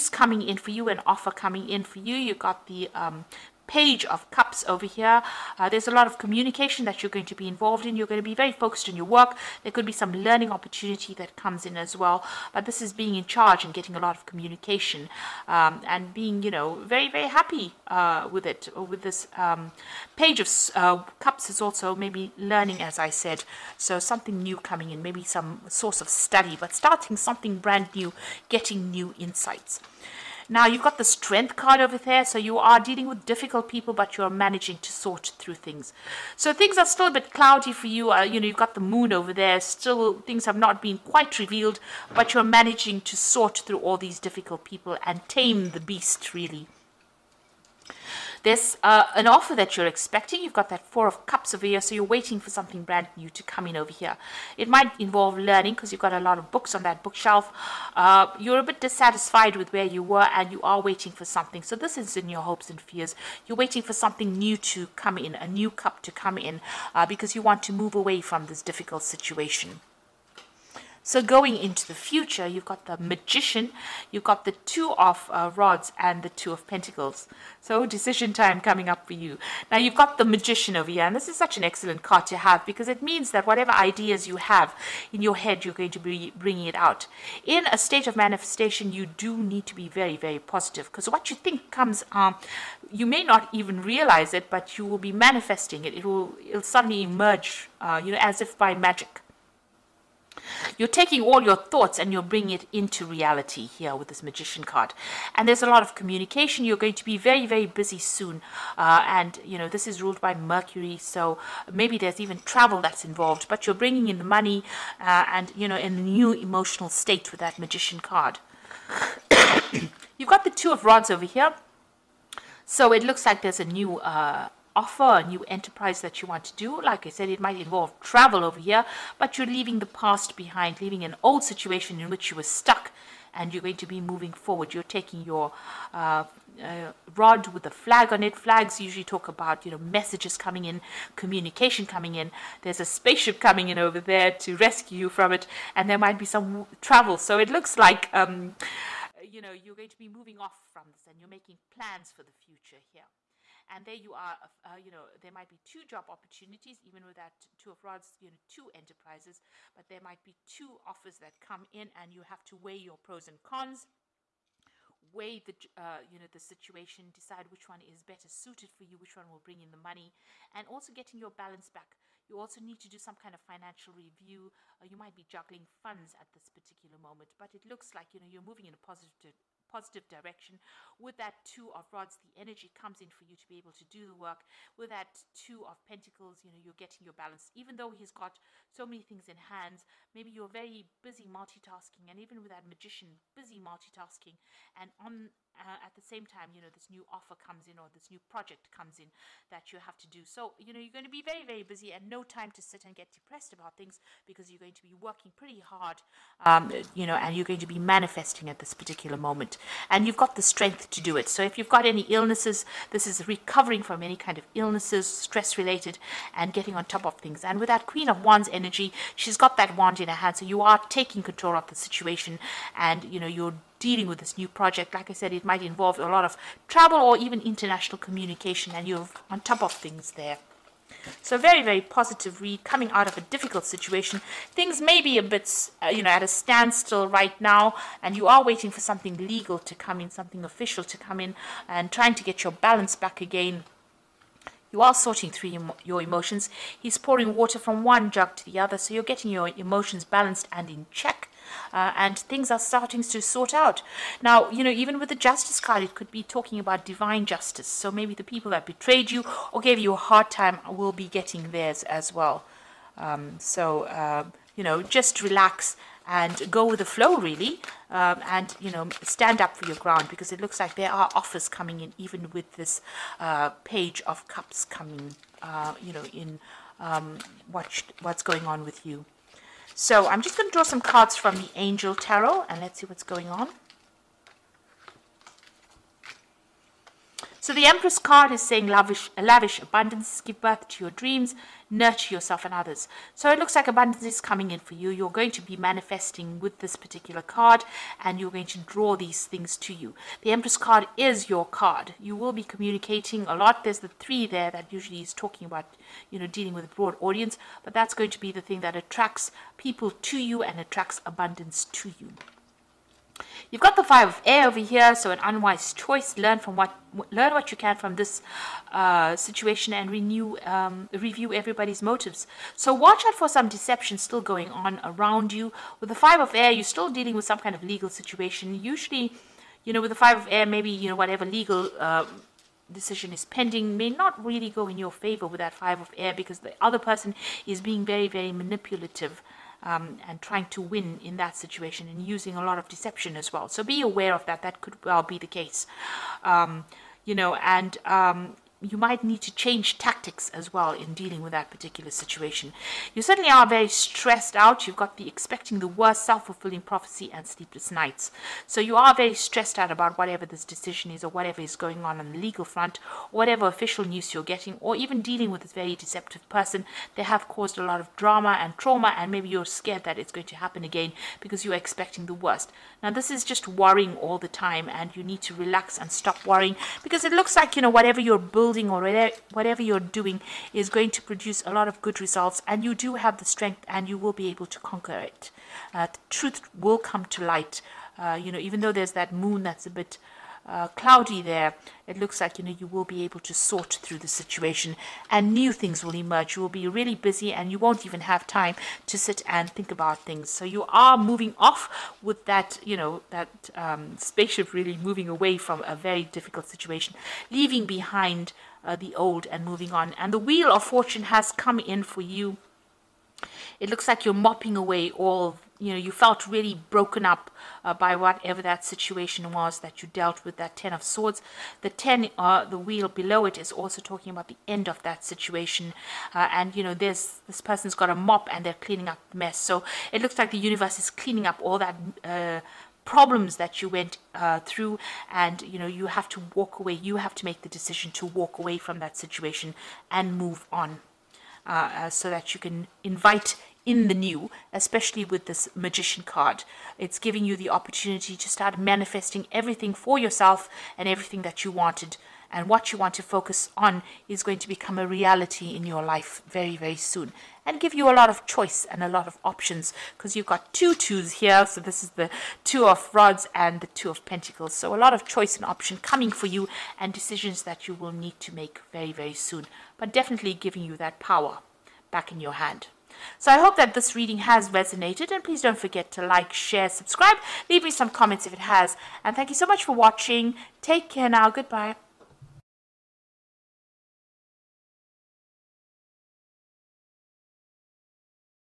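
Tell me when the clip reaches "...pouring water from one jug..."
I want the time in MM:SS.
04:06.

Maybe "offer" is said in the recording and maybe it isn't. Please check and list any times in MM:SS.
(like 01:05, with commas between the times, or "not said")
00:01, 00:49, 02:04, 02:40, 03:17, 04:31.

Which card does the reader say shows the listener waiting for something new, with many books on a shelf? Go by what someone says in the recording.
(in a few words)
Four of Cups.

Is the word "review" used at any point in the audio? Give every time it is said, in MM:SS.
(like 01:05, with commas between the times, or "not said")
02:53, 05:20.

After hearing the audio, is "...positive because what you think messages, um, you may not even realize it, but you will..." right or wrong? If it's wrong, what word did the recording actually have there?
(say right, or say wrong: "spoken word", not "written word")
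wrong: "comes", not "messages".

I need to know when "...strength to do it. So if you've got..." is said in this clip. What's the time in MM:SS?
03:30.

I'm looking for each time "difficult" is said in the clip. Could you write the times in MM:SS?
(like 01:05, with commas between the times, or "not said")
00:33, 00:44, 01:08, 03:53, 06:46.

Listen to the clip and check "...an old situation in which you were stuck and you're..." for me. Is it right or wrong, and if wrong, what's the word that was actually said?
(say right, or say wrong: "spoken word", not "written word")
right.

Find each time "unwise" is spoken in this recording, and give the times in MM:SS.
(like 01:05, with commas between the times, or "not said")
05:15.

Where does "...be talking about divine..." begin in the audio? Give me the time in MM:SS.
04:16.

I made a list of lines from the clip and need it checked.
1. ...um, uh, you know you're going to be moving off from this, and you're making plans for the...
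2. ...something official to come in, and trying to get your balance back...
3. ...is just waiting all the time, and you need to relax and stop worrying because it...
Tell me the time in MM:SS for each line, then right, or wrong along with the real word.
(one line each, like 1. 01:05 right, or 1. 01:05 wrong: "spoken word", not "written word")
1. 02:28 right
2. 04:00 right
3. 06:13 wrong: "worrying", not "waiting".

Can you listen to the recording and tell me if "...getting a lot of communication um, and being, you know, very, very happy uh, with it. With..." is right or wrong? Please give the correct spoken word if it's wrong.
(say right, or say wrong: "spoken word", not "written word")
right.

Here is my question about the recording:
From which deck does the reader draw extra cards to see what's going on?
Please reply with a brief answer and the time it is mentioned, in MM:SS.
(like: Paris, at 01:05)
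Angel Tarot, at 04:41.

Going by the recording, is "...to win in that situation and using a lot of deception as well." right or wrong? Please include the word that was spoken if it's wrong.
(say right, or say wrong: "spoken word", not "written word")
right.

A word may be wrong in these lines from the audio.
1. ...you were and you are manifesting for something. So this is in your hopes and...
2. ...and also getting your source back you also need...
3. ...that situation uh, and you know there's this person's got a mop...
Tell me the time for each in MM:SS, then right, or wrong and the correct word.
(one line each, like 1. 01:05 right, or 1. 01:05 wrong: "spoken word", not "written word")
1. 00:59 wrong: "waiting", not "manifesting"
2. 02:50 wrong: "balance", not "source"
3. 07:04 right.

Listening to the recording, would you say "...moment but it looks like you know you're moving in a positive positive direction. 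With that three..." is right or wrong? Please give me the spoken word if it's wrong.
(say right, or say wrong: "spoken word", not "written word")
wrong: "two", not "three".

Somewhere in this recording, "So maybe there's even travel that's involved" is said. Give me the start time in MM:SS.
01:50.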